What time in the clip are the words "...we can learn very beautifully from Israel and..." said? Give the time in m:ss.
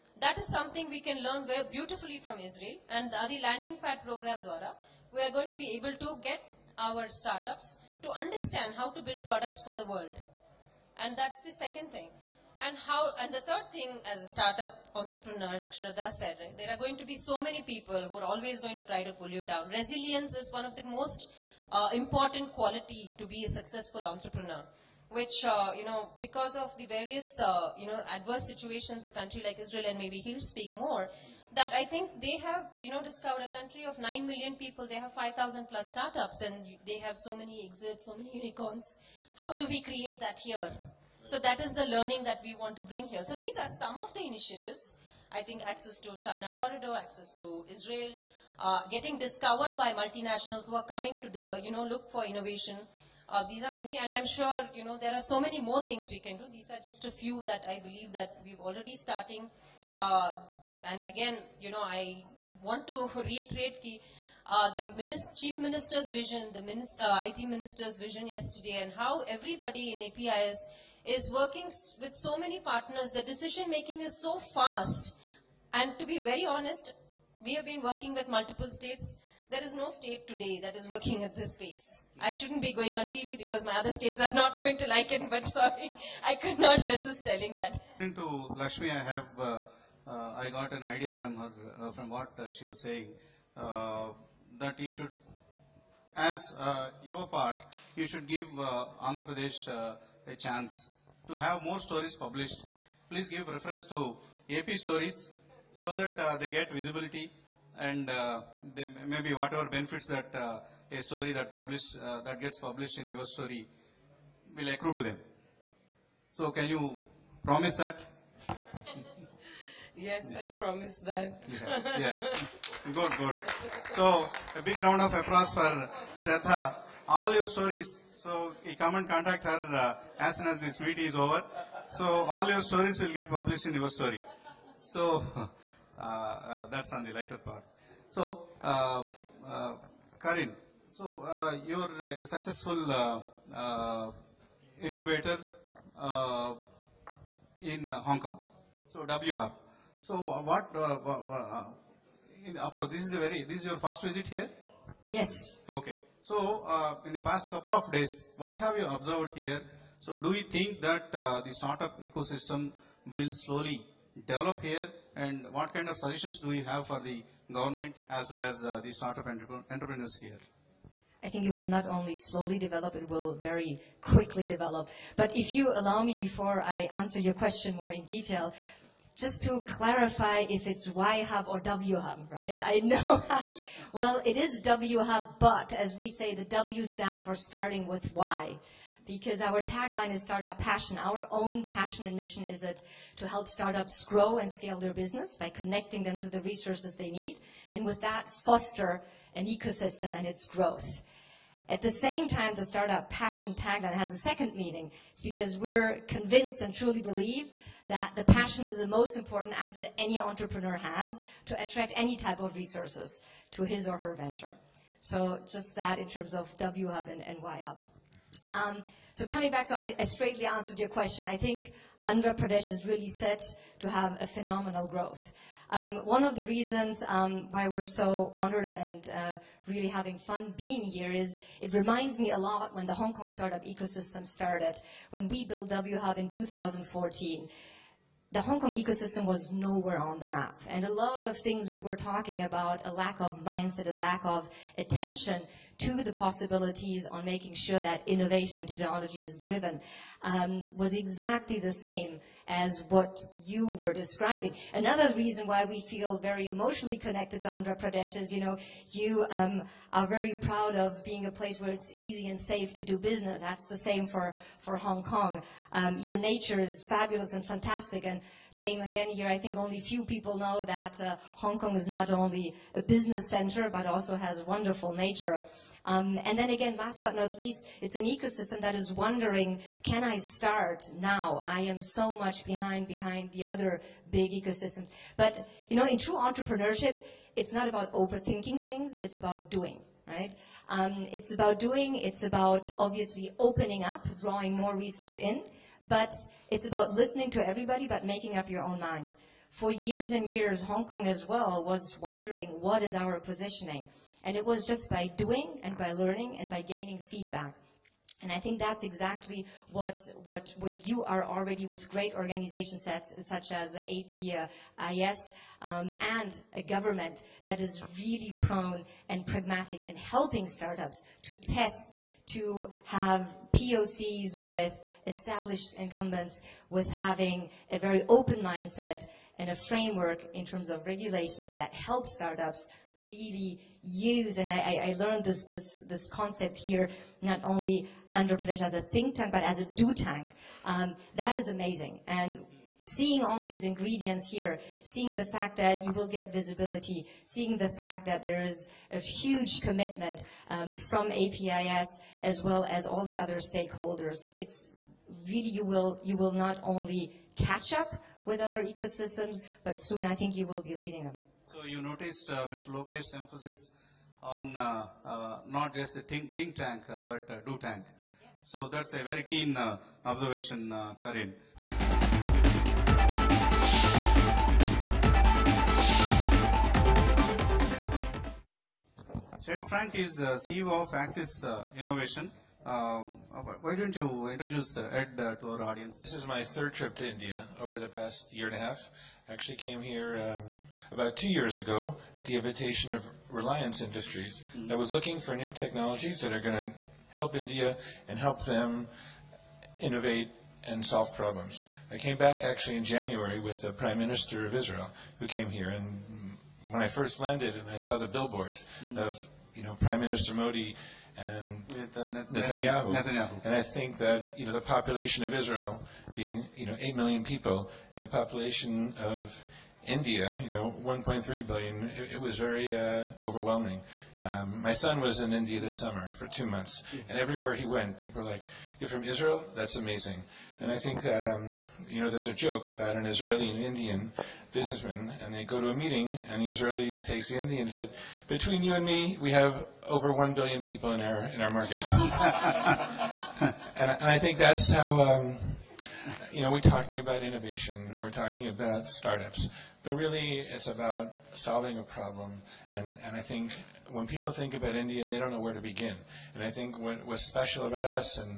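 0:00.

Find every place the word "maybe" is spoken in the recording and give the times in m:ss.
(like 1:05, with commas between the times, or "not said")
0:29, 1:49.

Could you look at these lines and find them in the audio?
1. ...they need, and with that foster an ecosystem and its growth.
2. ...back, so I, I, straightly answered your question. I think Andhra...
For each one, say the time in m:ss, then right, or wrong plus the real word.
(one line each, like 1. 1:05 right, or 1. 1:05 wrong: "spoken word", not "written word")
1. 3:16 right
2. 3:39 right.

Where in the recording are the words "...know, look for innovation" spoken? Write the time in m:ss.
0:51.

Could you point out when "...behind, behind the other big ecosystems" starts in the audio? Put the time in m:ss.
4:42.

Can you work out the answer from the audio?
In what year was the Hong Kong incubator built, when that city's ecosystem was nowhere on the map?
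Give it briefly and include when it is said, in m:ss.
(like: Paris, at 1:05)
2014, at 3:56.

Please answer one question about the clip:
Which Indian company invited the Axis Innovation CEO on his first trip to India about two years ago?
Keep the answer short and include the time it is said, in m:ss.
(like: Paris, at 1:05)
Reliance Industries, at 6:33.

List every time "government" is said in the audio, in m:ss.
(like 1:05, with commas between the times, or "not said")
2:47, 5:16.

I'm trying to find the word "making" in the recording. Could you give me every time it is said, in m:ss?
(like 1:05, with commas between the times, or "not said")
1:13, 4:07, 4:58.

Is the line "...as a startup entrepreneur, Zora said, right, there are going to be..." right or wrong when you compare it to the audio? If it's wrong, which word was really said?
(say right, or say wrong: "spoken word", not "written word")
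wrong: "Shraddha", not "Zora".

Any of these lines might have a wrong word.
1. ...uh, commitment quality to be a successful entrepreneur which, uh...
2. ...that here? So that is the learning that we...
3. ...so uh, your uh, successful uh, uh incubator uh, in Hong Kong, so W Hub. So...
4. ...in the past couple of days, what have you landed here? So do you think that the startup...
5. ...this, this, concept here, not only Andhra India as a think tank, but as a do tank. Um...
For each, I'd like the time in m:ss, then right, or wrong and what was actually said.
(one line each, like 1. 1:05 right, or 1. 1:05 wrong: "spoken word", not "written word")
1. 0:21 wrong: "important", not "commitment"
2. 0:40 right
3. 2:20 right
4. 2:37 wrong: "observed", not "landed"
5. 5:35 wrong: "Pradesh", not "India".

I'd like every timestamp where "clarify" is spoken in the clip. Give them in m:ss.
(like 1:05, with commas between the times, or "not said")
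2:59.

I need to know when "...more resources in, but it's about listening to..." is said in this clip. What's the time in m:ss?
4:54.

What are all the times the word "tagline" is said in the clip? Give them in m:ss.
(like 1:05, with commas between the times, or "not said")
3:09, 3:23.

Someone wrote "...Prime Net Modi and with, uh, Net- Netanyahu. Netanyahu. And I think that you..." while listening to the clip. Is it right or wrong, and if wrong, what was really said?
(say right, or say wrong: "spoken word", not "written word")
wrong: "Minister", not "Net".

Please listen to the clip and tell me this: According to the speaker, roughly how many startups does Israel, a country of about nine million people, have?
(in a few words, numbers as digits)
5,000 plus.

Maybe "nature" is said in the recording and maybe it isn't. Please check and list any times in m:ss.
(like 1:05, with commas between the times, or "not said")
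4:26, 4:34.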